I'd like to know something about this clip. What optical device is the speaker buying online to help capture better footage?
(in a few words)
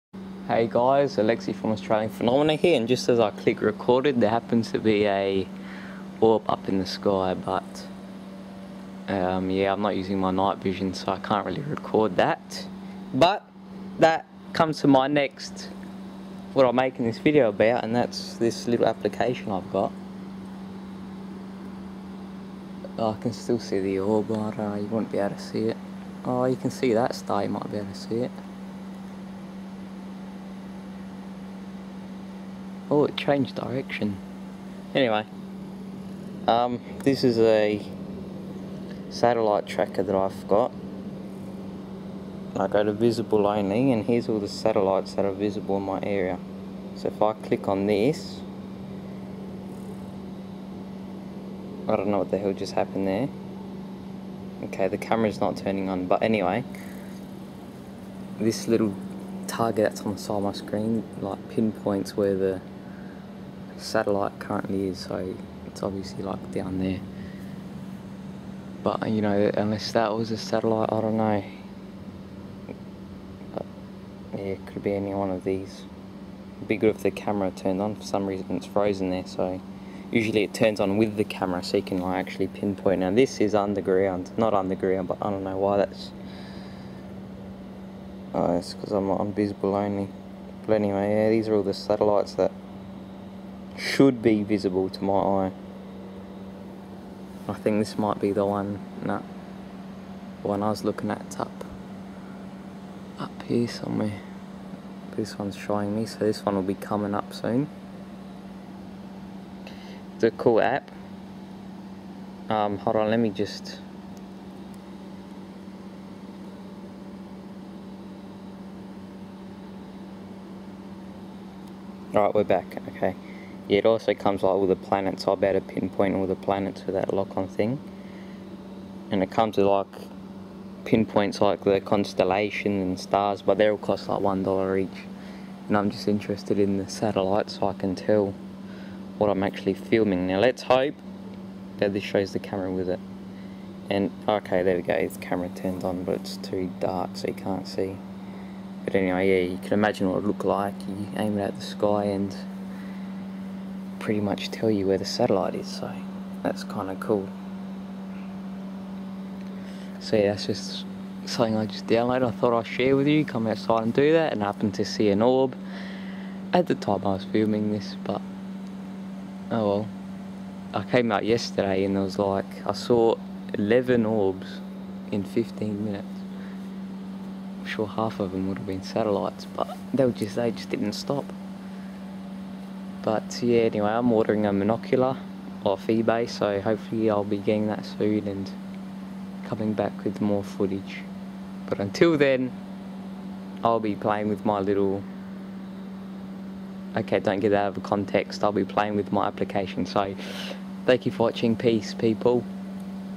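A monocular.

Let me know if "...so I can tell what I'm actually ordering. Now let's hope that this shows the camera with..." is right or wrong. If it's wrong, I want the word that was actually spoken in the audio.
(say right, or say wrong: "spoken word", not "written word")
wrong: "filming", not "ordering".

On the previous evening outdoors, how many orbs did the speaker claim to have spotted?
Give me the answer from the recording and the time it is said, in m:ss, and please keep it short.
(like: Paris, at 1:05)
11, at 2:53.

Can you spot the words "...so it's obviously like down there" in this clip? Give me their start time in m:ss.
1:04.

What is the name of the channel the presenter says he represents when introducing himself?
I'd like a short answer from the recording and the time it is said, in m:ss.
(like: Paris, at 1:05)
Australian Phenomena, at 0:01.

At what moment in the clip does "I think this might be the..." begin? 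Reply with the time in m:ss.
1:37.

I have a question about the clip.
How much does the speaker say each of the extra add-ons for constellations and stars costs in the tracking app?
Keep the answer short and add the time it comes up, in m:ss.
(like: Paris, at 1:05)
$1, at 2:14.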